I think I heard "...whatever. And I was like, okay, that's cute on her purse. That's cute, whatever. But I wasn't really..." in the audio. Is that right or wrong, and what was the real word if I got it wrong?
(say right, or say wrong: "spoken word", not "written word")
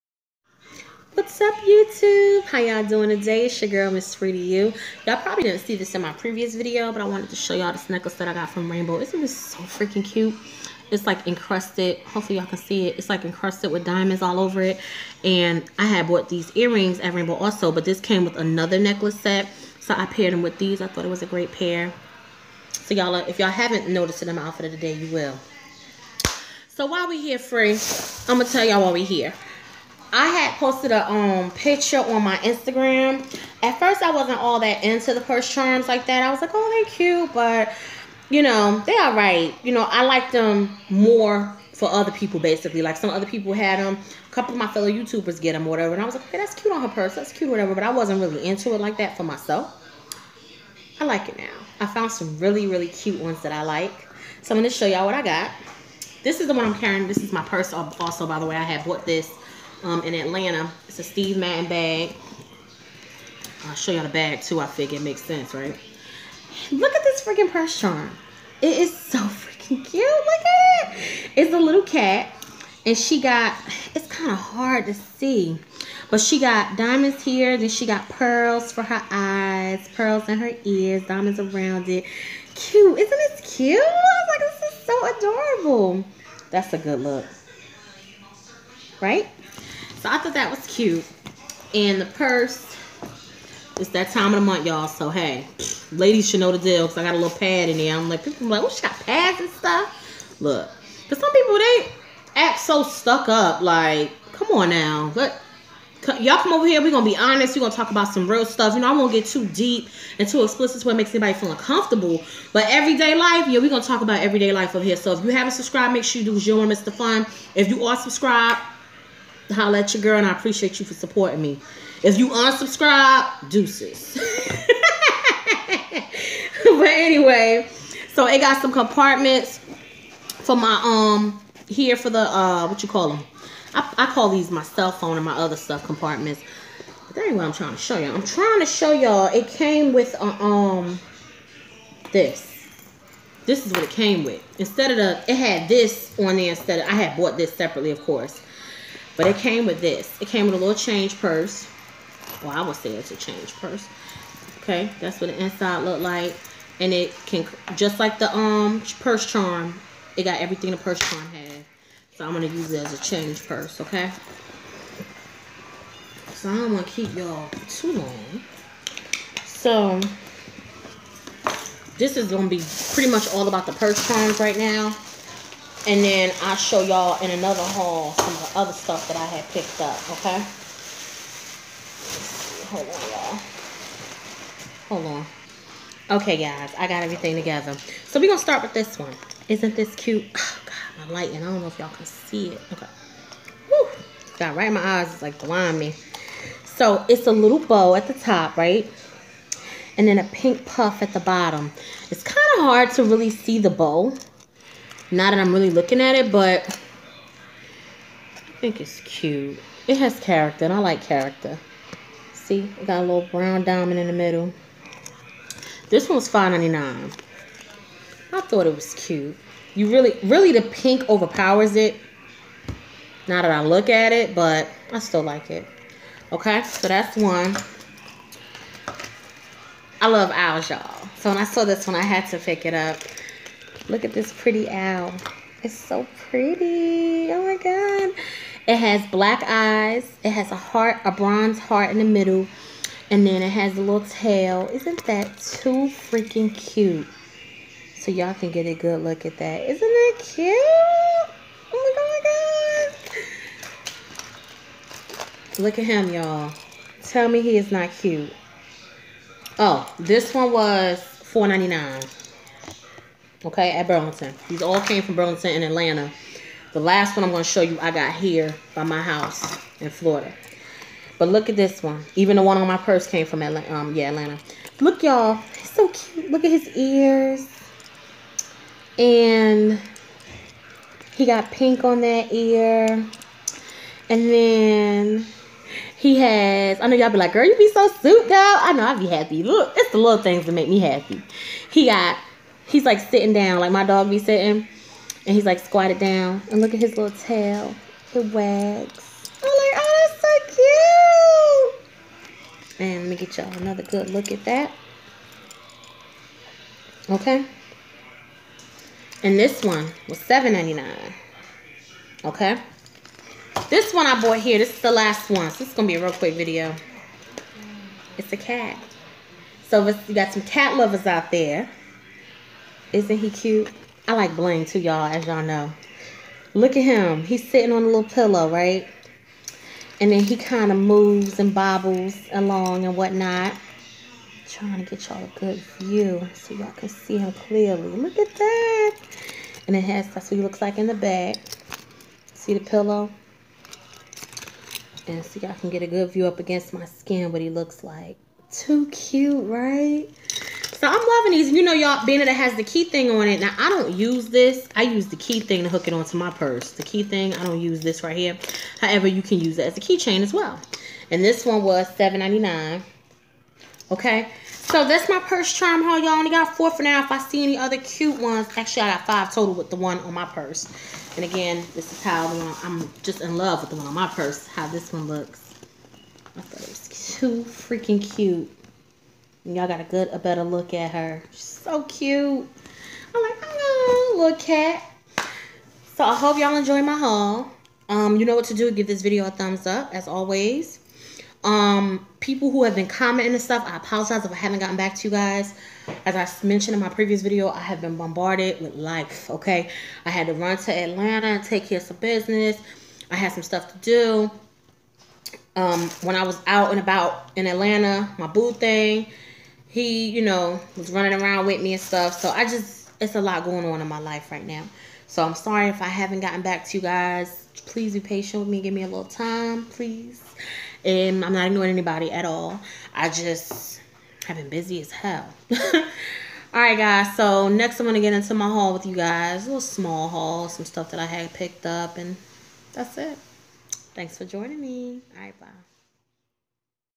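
right.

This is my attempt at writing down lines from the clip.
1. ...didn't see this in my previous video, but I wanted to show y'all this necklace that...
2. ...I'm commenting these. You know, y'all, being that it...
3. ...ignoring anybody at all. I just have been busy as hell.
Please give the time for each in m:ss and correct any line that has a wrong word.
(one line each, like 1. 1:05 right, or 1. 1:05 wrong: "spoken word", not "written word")
1. 0:05 right
2. 5:50 wrong: "loving", not "commenting"
3. 7:01 right.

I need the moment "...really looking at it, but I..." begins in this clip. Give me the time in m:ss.
3:25.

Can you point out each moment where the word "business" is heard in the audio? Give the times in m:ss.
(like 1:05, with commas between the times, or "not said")
6:41.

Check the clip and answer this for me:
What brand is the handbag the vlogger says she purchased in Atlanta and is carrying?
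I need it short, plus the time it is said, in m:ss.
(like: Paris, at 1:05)
Steve Madden, at 1:01.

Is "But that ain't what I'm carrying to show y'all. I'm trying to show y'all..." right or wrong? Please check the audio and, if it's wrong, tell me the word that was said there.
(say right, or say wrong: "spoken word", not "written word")
wrong: "trying", not "carrying".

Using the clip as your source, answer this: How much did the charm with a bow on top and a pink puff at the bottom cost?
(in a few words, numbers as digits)
$5.99.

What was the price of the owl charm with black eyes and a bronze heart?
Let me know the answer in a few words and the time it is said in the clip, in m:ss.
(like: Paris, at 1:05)
$4.99, at 4:20.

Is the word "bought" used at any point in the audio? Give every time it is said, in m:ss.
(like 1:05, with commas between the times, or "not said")
0:16, 0:58, 2:27, 5:14.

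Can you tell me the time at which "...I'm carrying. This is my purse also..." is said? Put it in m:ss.
0:56.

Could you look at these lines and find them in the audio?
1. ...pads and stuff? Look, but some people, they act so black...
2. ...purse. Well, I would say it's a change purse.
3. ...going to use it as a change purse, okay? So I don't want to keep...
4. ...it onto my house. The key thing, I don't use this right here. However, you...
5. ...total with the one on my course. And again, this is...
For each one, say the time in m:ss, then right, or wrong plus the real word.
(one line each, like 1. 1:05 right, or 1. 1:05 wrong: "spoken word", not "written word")
1. 1:38 wrong: "stuck", not "black"
2. 2:31 right
3. 2:42 right
4. 5:55 wrong: "purse", not "house"
5. 6:09 wrong: "purse", not "course".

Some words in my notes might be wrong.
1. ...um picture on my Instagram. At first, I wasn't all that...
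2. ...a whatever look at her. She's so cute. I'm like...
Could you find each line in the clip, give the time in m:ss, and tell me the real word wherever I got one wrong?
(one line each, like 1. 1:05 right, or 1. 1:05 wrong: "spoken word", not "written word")
1. 0:31 right
2. 6:20 wrong: "better", not "whatever".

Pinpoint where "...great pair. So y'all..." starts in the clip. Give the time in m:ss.
0:21.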